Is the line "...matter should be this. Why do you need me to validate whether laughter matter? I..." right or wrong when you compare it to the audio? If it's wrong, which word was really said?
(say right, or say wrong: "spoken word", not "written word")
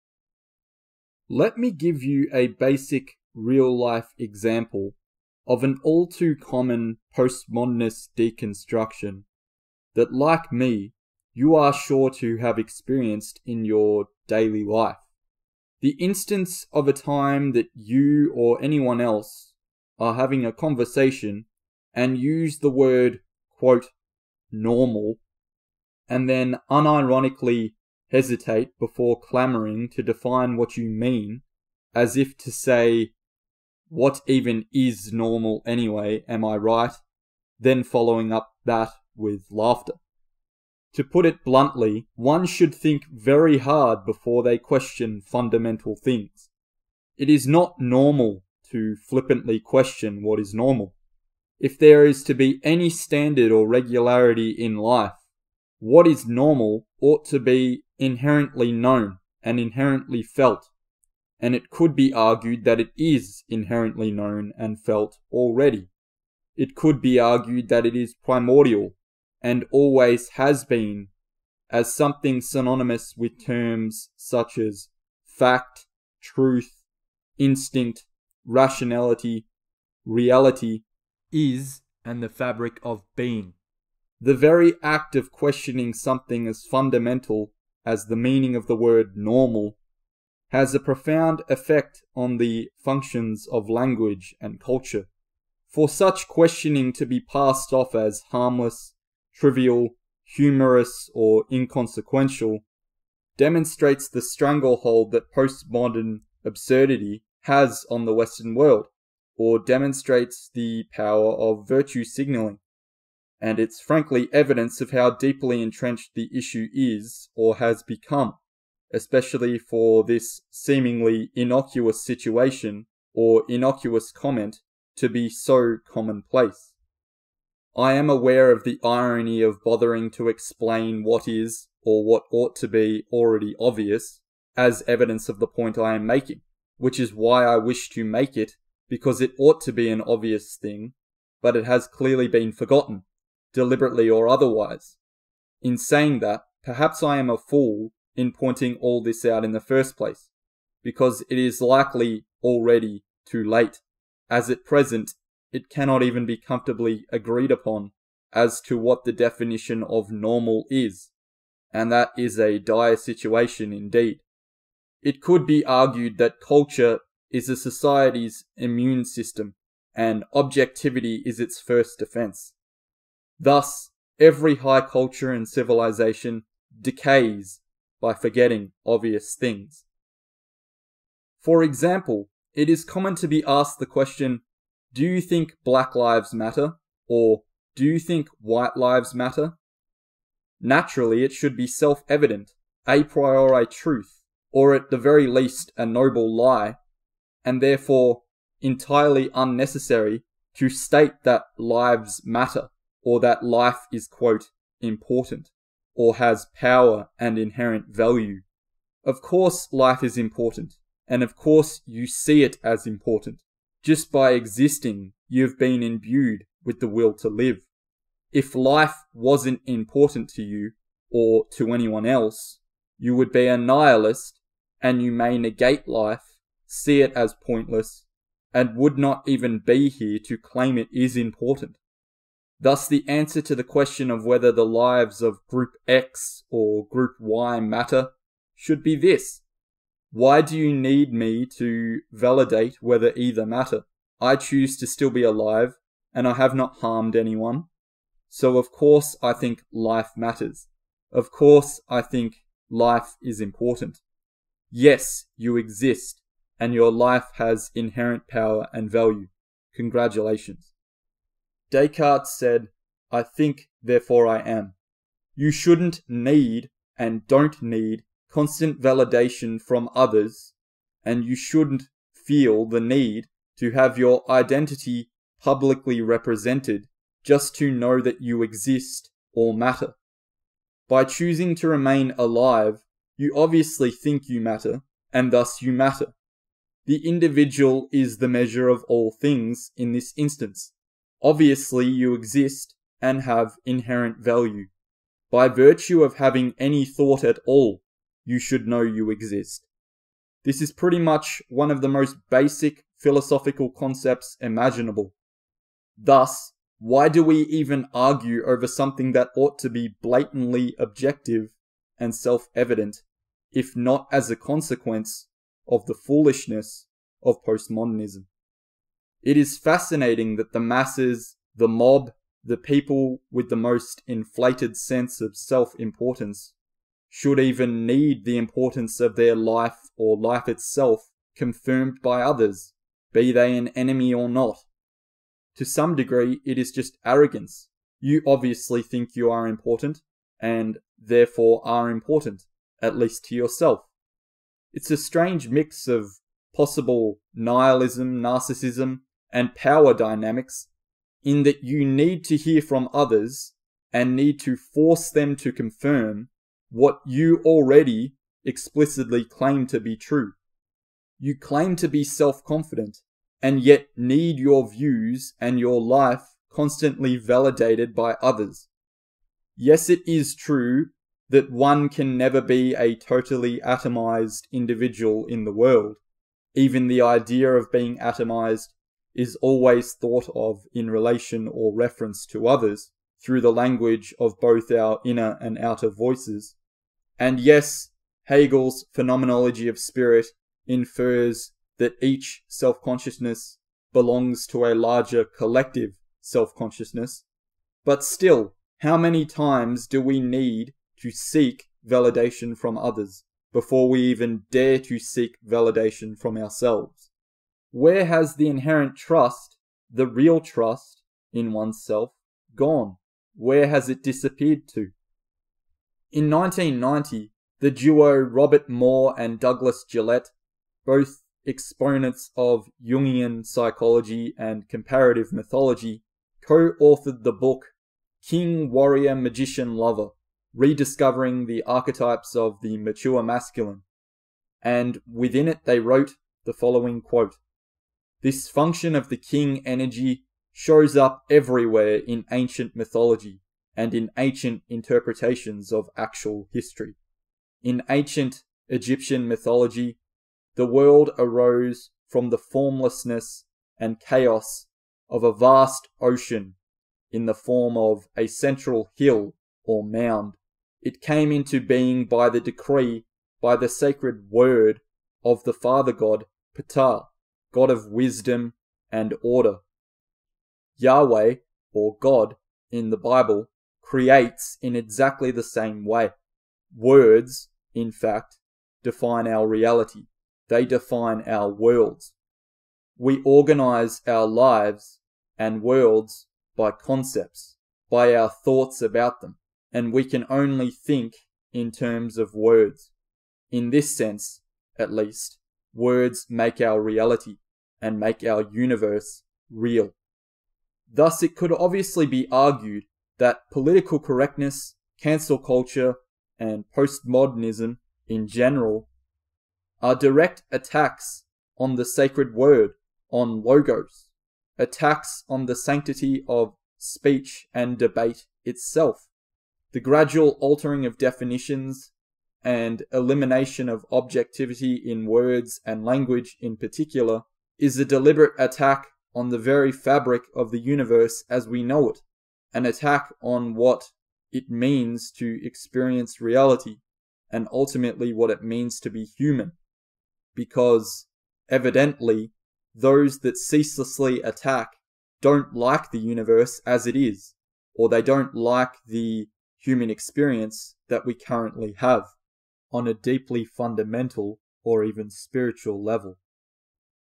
wrong: "either", not "laughter".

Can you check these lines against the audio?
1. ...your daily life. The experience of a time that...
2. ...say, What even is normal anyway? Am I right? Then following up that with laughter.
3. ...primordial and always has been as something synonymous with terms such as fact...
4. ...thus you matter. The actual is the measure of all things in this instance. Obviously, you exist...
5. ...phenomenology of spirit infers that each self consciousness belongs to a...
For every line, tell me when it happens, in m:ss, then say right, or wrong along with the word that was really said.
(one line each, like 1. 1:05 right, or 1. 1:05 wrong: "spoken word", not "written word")
1. 0:13 wrong: "instance", not "experience"
2. 0:32 right
3. 1:08 right
4. 4:45 wrong: "individual", not "actual"
5. 6:28 right.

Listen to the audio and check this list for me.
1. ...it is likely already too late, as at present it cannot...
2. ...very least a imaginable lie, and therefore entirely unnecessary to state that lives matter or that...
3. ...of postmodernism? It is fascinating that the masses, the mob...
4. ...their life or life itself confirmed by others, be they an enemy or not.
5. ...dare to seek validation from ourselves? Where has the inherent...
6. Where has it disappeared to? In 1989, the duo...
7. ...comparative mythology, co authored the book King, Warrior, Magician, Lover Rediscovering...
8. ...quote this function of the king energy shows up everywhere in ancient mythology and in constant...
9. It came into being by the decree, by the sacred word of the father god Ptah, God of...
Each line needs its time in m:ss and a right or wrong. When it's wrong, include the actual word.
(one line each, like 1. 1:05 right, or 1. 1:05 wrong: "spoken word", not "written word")
1. 2:31 right
2. 3:14 wrong: "noble", not "imaginable"
3. 5:17 right
4. 5:29 right
5. 6:44 right
6. 6:53 wrong: "1990", not "1989"
7. 7:04 right
8. 7:17 wrong: "ancient", not "constant"
9. 7:40 right.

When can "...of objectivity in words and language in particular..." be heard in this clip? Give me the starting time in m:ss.
8:43.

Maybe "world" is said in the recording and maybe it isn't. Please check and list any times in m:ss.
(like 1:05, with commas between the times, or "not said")
1:48, 6:15, 7:30, 8:01, 8:05.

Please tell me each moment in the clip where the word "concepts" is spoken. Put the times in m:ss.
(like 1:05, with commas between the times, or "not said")
5:03, 8:06.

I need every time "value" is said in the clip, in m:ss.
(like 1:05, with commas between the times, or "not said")
3:27, 4:18, 4:54.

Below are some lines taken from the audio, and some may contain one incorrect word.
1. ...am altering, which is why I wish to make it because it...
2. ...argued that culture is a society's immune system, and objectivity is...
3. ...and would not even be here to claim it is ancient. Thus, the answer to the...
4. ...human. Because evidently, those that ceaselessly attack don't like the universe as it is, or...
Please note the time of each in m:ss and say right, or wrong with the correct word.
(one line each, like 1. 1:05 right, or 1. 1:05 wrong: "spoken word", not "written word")
1. 2:15 wrong: "making", not "altering"
2. 2:45 right
3. 3:48 wrong: "important", not "ancient"
4. 8:59 right.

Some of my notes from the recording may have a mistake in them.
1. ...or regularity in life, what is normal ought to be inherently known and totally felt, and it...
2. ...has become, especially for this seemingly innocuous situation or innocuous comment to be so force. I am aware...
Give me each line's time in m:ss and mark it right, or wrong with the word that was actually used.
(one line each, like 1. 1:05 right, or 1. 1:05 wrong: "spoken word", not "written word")
1. 0:53 wrong: "inherently", not "totally"
2. 1:57 wrong: "commonplace", not "force".